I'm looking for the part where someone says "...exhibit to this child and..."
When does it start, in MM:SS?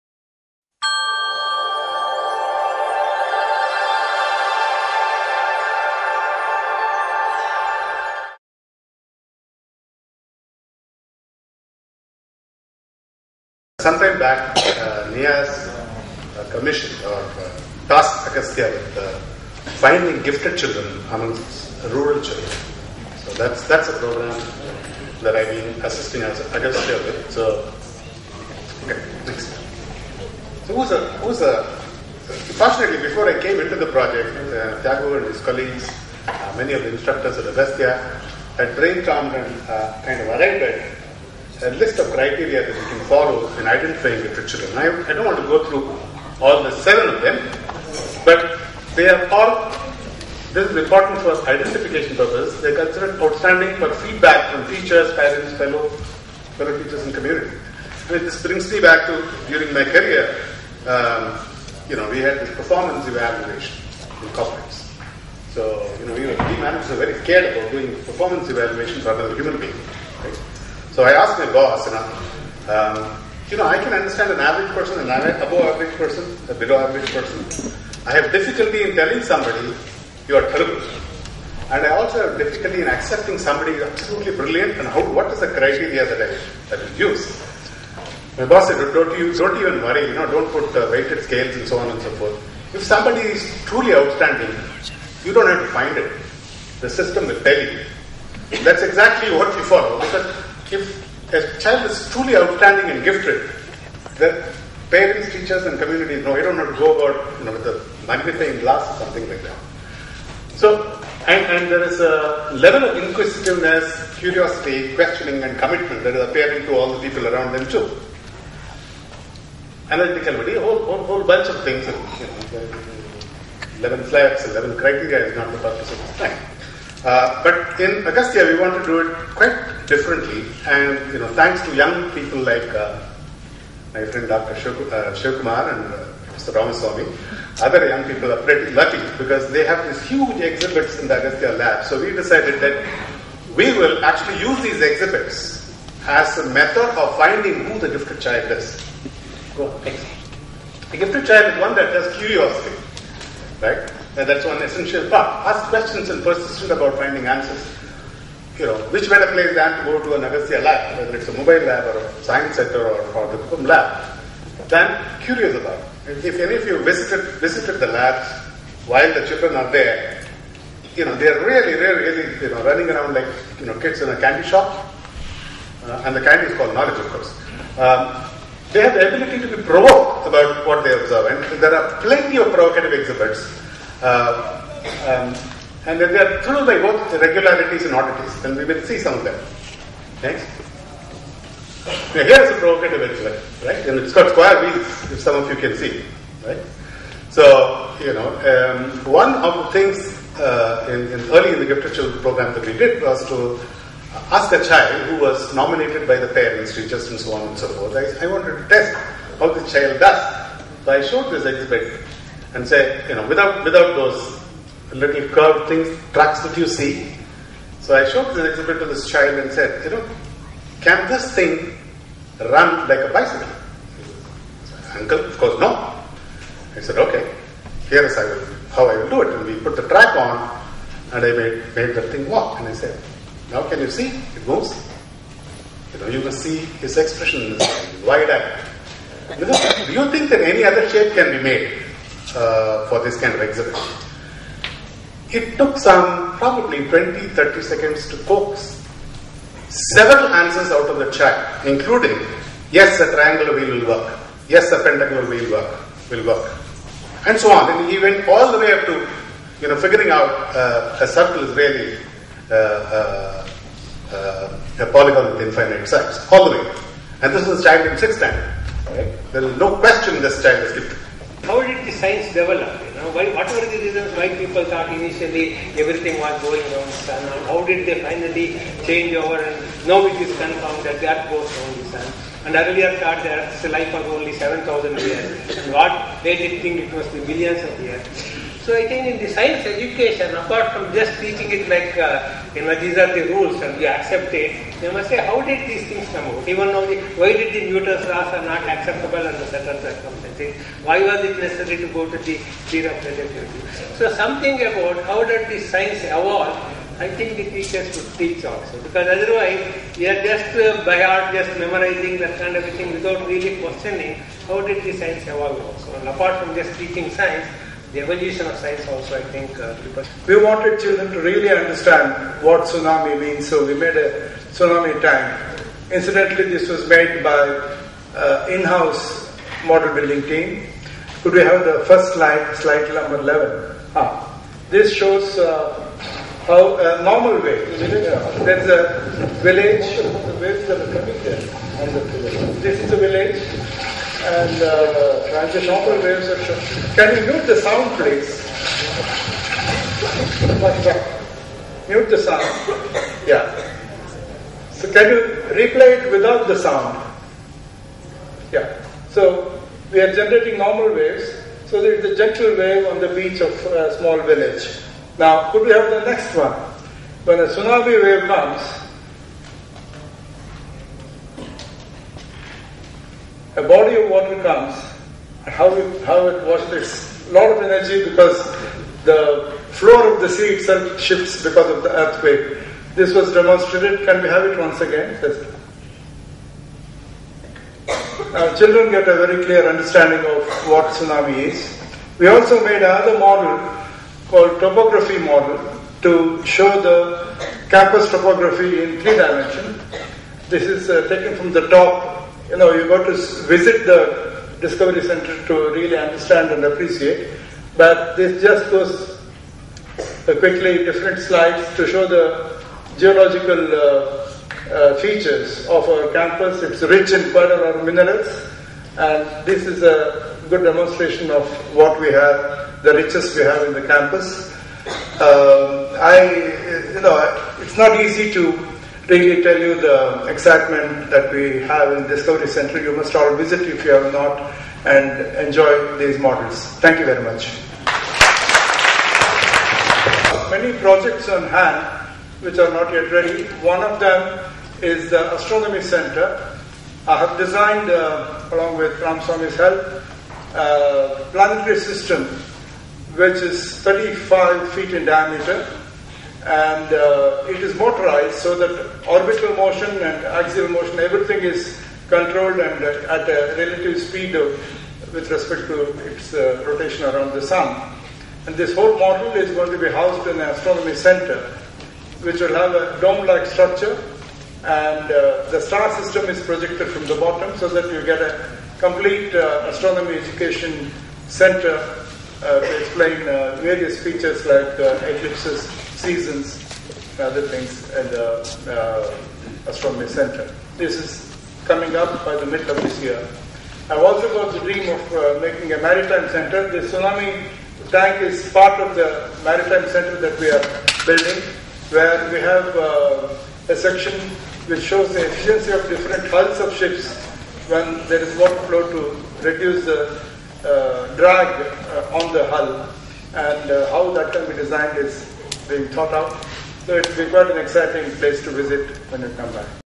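03:38.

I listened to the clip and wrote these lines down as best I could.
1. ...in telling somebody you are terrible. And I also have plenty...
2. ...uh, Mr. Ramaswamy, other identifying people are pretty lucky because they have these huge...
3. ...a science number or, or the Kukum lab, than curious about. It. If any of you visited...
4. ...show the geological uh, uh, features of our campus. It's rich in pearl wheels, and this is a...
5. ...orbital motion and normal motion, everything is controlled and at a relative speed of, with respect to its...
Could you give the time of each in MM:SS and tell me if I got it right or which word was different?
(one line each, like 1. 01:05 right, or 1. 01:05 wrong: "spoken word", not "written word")
1. 01:18 wrong: "difficulty", not "plenty"
2. 02:15 wrong: "young", not "identifying"
3. 02:41 wrong: "center", not "number"
4. 06:51 wrong: "minerals", not "wheels"
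5. 07:39 wrong: "axial", not "normal".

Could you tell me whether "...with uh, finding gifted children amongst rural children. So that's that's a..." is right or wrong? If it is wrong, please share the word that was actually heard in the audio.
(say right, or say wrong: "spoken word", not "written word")
right.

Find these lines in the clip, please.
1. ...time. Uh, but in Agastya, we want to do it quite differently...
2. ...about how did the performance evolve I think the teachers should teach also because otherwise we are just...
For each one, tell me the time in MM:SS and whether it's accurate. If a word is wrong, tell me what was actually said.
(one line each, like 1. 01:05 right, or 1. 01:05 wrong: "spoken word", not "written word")
1. 02:06 right
2. 05:04 wrong: "science", not "performance".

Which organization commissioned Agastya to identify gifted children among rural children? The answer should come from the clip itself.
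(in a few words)
NIAS.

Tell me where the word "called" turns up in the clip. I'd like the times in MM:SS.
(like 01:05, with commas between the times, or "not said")
02:56, 06:34.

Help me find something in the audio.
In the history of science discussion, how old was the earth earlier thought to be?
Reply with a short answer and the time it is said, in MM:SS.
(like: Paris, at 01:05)
7,000 years, at 04:44.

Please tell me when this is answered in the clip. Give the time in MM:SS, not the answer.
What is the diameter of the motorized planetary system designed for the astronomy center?
07:33.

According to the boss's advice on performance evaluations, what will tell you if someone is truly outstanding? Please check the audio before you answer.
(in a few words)
The system.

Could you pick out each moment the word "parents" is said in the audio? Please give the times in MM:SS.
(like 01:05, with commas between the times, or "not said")
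00:55, 01:44, 03:26.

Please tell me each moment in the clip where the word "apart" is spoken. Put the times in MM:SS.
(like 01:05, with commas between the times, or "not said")
04:50, 05:16.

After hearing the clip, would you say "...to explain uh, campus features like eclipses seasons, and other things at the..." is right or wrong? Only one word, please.
wrong.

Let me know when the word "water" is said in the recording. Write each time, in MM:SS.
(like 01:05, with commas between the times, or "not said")
06:14, 08:28.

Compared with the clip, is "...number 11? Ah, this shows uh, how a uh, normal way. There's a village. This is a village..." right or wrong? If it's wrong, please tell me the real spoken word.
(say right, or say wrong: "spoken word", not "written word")
right.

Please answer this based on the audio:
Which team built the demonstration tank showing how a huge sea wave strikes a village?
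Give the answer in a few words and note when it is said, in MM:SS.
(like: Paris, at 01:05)
In-house model building team, at 05:28.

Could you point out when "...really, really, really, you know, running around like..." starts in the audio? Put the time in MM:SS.
02:51.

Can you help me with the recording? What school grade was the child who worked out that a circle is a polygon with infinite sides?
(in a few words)
Sixth standard.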